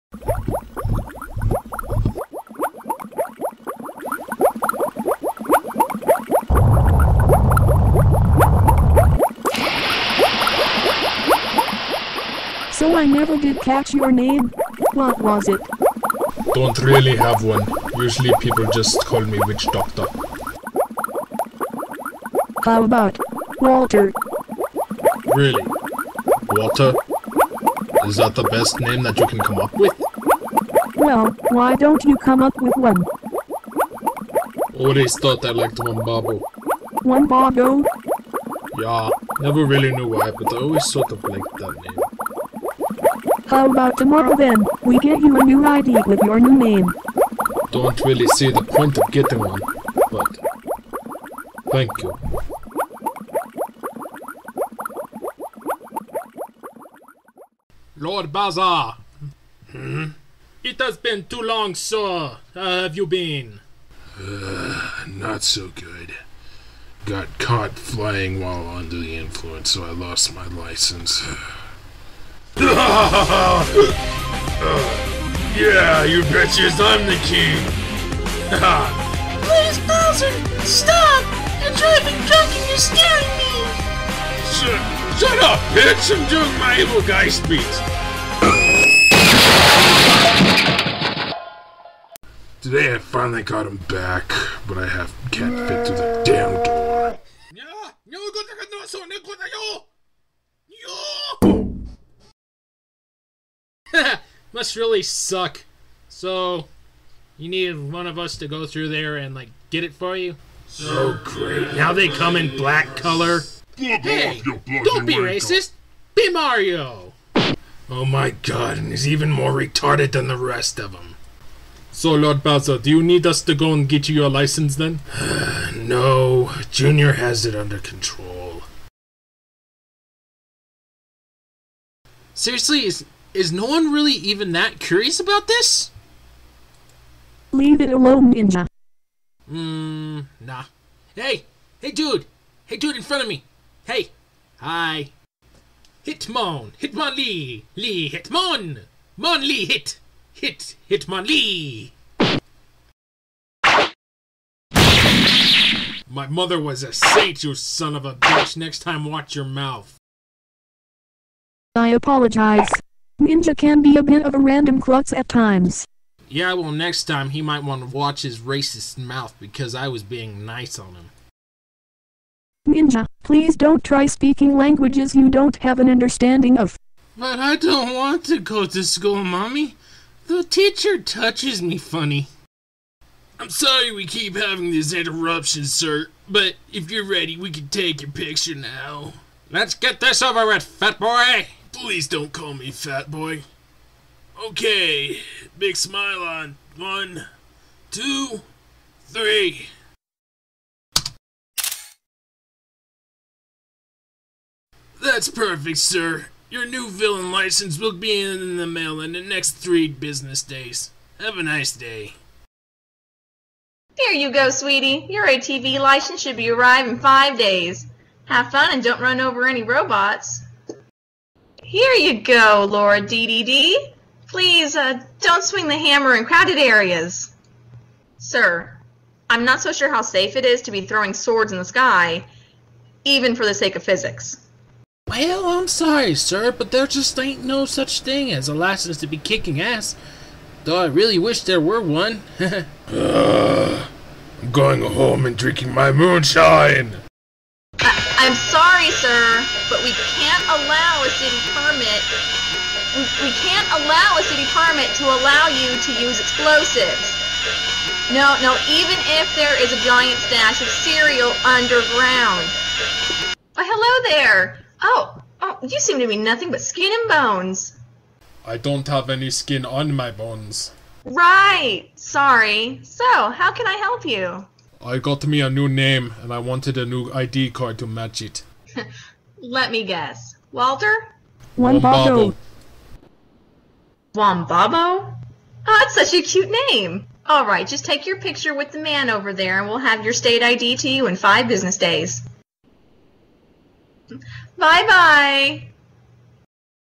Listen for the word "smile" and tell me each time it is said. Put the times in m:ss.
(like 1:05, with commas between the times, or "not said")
3:15.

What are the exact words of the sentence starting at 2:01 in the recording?
So, Lord Bowser, do you need us to go and get you your license then?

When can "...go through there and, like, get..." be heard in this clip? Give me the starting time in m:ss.
1:48.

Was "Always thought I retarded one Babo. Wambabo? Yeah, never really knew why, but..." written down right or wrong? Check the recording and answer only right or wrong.
wrong.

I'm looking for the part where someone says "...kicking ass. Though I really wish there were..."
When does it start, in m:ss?
3:59.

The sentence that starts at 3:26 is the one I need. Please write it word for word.
Your new villain license will be in the mail in the next three business days.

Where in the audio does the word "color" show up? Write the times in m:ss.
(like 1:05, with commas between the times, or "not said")
1:52.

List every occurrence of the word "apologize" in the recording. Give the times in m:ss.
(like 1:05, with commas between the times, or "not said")
2:41.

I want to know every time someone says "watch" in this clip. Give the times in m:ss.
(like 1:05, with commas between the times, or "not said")
2:39, 2:47.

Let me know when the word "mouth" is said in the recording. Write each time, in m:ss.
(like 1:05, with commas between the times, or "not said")
2:39, 2:48.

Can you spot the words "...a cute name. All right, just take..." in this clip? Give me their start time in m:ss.
4:46.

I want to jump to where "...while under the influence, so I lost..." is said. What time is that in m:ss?
1:08.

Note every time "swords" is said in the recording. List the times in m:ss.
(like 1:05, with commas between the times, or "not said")
3:51.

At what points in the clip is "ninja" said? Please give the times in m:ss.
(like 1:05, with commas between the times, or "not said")
2:18, 2:43, 2:52.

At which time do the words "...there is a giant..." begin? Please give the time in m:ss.
4:19.